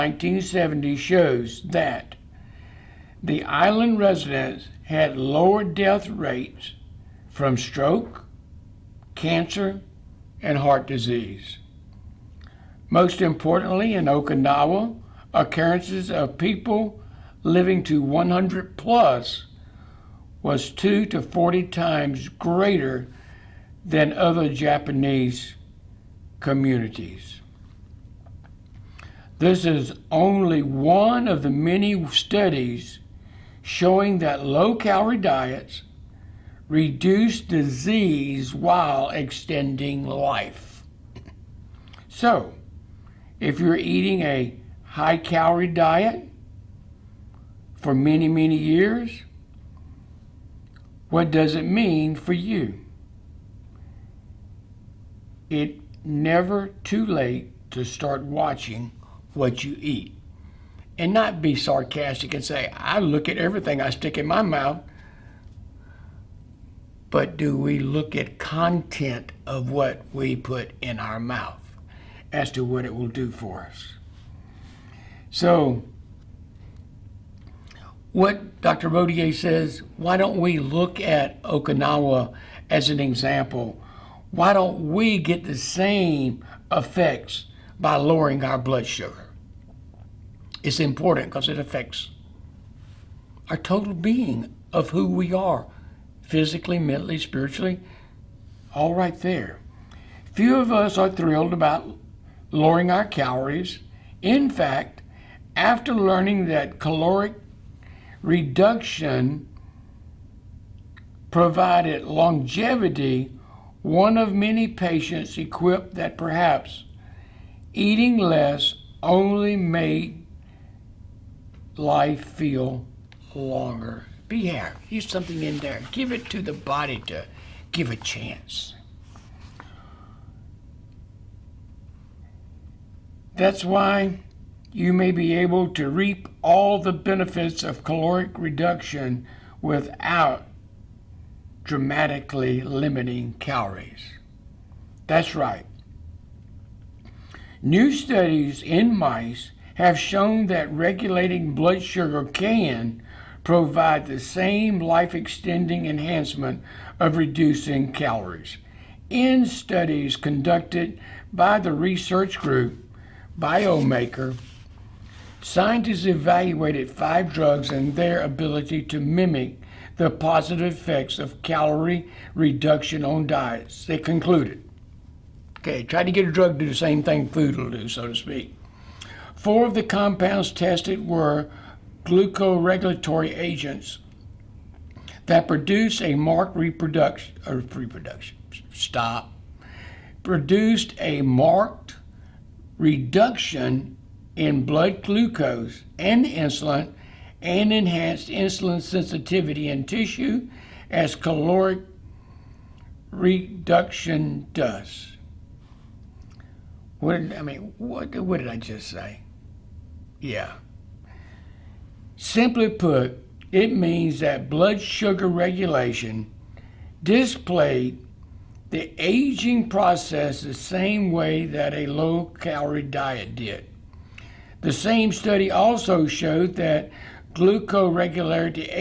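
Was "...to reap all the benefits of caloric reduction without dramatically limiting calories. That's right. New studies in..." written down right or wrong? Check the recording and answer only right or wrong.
right.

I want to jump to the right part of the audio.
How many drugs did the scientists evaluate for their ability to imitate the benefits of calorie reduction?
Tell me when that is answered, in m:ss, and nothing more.
2:46.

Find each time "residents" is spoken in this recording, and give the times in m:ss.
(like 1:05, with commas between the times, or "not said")
0:03.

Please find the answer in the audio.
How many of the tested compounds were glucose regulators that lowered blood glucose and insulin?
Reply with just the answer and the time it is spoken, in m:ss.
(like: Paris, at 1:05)
4, at 2:59.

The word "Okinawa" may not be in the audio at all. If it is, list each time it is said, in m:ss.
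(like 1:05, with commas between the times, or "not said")
0:14, 1:21.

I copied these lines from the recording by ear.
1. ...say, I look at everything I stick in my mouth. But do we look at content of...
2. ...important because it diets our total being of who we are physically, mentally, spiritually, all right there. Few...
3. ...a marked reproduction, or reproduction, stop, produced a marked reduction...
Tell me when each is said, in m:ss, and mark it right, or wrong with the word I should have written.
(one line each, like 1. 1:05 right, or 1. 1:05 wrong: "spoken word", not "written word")
1. 1:02 right
2. 1:30 wrong: "affects", not "diets"
3. 3:06 right.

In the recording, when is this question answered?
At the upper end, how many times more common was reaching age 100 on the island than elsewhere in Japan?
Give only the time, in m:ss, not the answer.
0:21.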